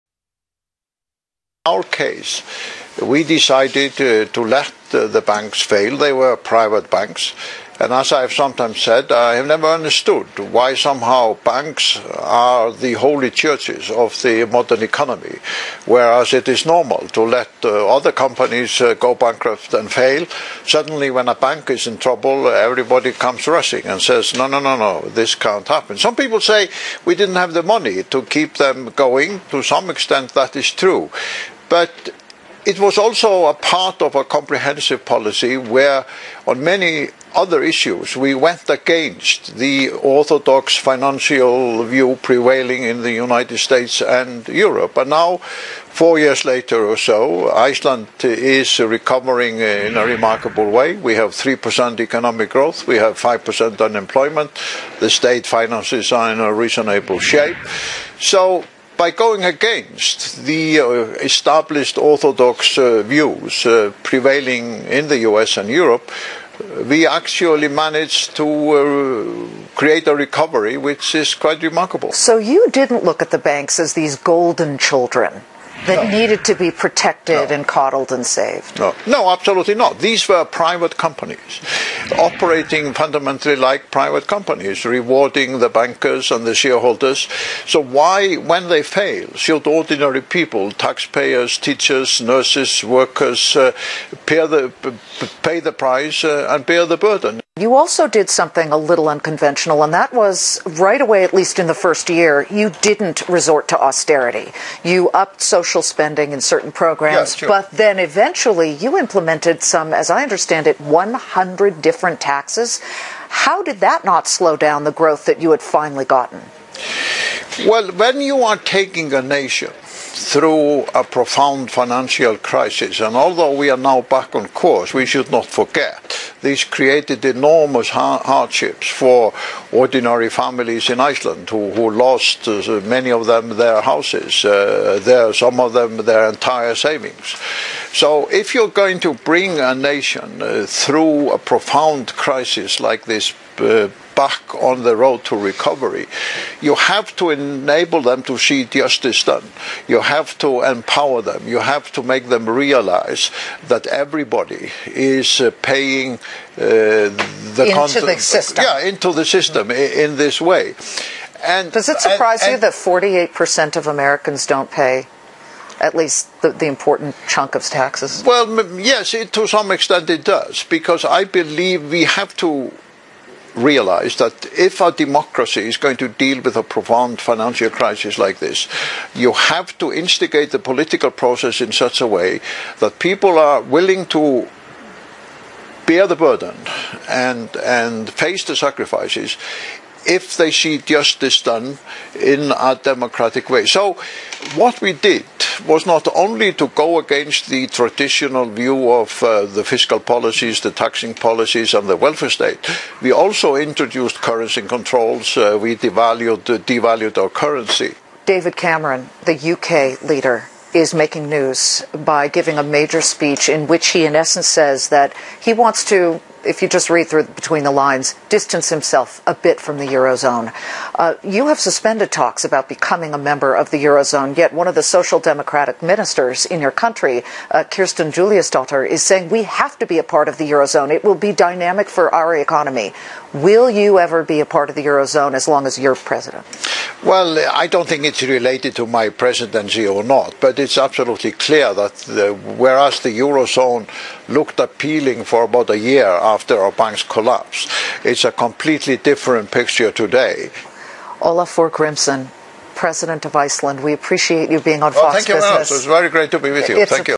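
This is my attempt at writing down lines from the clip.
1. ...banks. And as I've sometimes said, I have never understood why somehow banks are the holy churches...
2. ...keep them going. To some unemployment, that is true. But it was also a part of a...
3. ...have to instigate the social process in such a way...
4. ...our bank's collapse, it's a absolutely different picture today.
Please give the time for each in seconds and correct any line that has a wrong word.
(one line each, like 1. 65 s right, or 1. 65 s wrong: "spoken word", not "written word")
1. 6 s right
2. 28 s wrong: "extent", not "unemployment"
3. 179 s wrong: "political", not "social"
4. 246 s wrong: "completely", not "absolutely".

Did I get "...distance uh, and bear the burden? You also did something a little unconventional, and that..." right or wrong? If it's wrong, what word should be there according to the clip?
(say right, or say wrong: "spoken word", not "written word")
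wrong: "price", not "distance".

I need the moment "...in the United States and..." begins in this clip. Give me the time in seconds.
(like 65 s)
42 s.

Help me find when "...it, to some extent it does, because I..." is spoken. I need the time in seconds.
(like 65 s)
169 s.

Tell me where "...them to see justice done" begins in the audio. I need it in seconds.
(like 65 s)
148 s.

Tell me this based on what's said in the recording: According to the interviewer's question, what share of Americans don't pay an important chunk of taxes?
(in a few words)
48%.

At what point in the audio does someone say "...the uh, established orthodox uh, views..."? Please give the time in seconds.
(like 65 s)
60 s.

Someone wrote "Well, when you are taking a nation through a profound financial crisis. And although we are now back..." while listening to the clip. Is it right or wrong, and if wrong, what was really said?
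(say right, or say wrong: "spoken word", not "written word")
right.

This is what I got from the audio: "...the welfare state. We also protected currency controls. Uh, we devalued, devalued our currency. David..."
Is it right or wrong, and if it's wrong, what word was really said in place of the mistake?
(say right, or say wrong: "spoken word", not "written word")
wrong: "introduced", not "protected".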